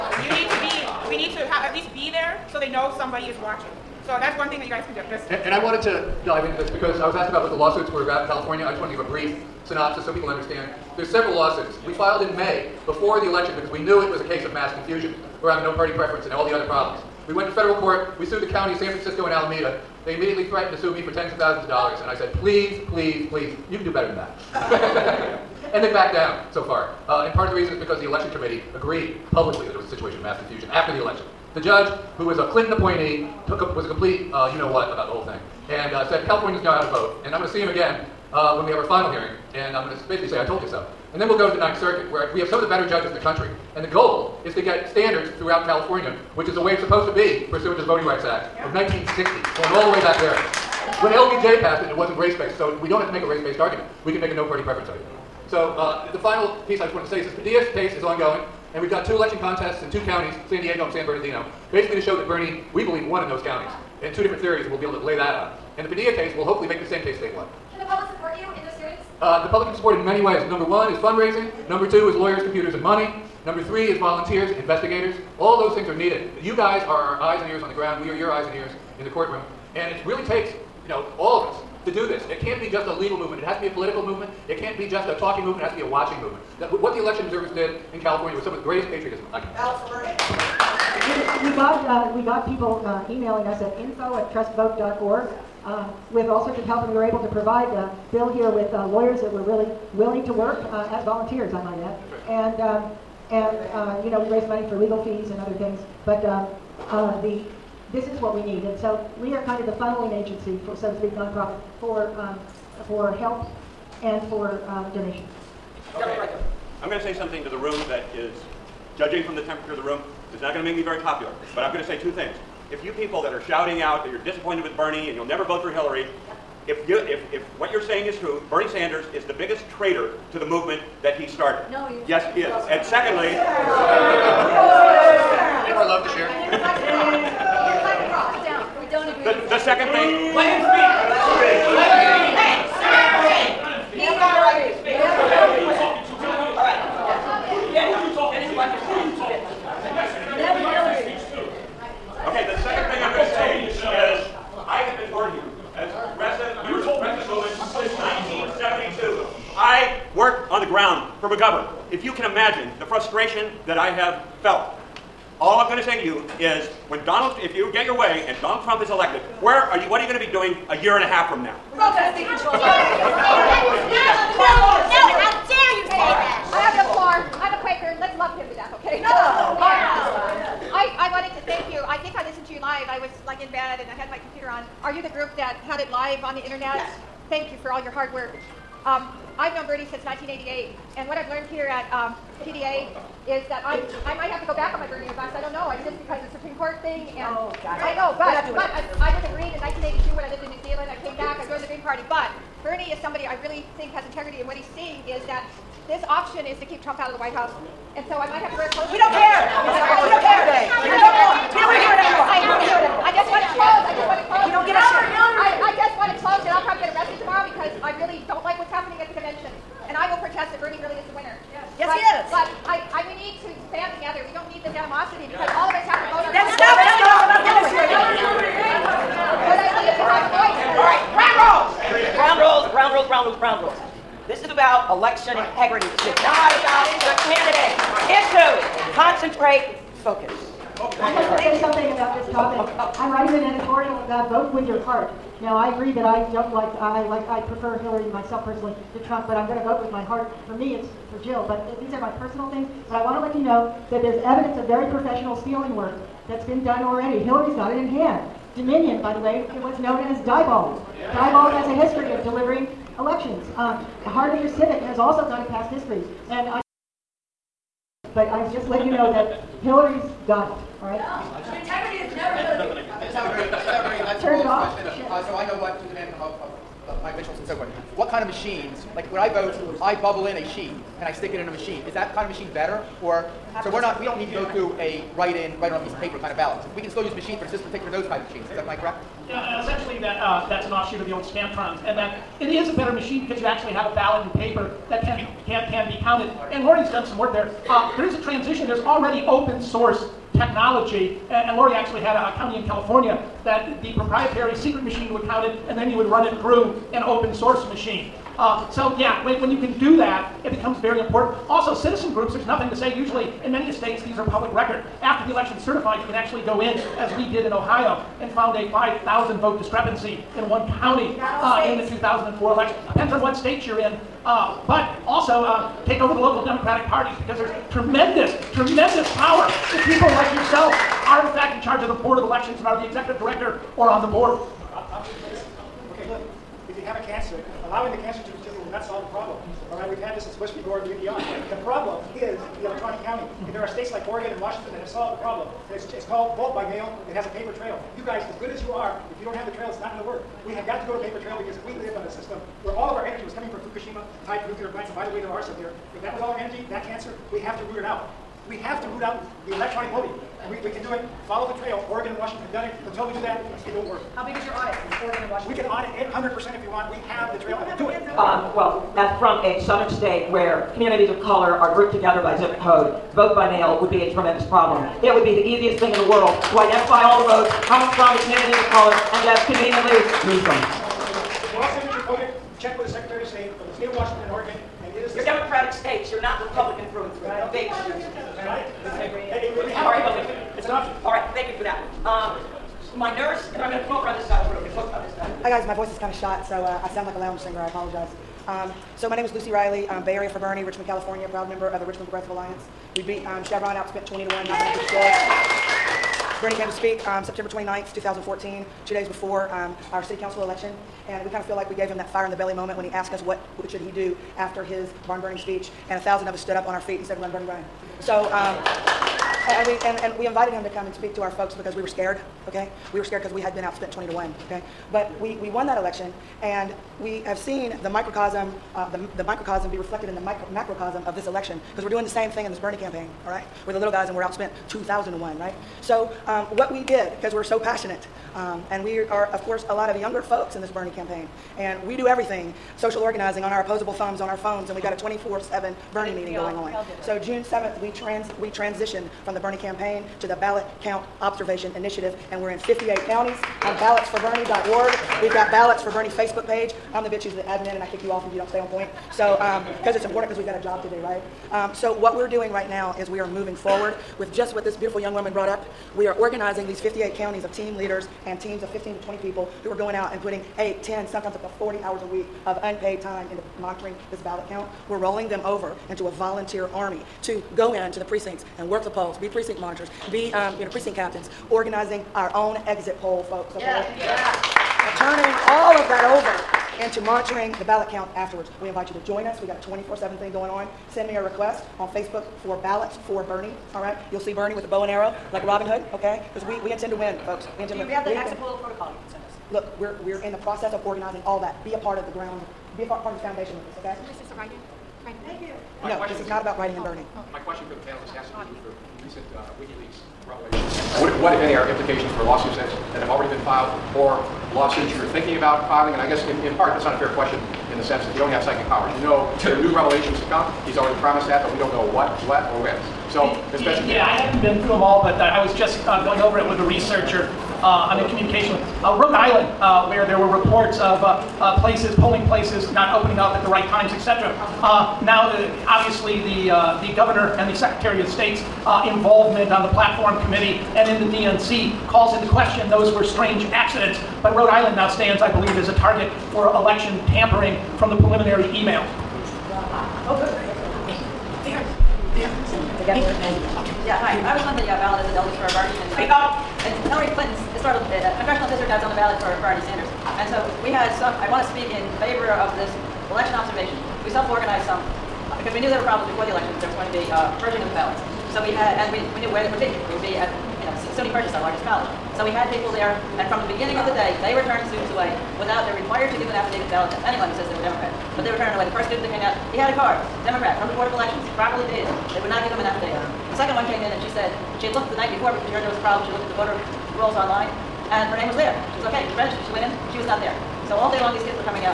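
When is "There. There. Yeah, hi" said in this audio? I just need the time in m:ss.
9:11.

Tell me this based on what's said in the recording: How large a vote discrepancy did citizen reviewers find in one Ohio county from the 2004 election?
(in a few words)
5,000.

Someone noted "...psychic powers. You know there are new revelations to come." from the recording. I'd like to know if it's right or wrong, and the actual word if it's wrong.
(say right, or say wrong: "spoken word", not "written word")
right.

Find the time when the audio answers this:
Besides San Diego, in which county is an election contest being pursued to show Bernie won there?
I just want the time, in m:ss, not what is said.
1:00.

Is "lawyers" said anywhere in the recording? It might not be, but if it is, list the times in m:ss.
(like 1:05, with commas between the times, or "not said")
1:12, 1:38.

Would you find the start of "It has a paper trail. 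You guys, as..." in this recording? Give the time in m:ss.
5:47.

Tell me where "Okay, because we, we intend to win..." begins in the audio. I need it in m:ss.
8:15.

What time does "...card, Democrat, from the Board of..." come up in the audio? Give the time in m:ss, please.
9:39.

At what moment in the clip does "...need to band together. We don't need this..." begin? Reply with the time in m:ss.
3:43.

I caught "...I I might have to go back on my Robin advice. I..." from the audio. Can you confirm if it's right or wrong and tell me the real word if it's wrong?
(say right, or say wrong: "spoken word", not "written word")
wrong: "Bernie", not "Robin".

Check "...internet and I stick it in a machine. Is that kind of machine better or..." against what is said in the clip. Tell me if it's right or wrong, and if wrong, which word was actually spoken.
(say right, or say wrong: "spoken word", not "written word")
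wrong: "sheet", not "internet".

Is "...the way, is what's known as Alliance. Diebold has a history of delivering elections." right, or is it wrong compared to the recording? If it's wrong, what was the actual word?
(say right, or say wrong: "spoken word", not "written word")
wrong: "Diebold", not "Alliance".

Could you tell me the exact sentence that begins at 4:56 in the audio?
And Lori's done some work there.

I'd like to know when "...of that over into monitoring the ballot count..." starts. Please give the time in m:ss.
8:05.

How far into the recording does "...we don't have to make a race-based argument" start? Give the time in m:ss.
0:52.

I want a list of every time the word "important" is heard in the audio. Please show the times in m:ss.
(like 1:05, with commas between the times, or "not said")
5:10, 7:40.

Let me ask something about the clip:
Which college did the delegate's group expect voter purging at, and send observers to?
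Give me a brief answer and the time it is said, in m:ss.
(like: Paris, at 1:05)
SUNY Purchase, at 9:30.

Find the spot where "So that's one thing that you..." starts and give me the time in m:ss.
0:04.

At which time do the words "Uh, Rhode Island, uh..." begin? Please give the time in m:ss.
8:48.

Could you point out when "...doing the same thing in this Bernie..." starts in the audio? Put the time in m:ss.
7:11.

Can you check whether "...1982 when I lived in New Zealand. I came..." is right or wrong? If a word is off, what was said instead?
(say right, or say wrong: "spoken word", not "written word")
right.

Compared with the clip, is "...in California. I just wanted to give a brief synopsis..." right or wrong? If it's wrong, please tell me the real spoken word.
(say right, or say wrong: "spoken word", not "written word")
right.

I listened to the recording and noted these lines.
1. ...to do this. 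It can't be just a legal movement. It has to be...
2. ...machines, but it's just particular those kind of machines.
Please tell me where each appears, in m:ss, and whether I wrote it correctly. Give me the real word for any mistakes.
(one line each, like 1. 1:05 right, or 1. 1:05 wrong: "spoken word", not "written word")
1. 1:21 right
2. 4:47 right.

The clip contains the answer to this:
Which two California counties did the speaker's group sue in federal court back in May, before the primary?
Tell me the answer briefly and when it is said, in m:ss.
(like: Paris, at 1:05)
San Francisco and Alameda, at 0:18.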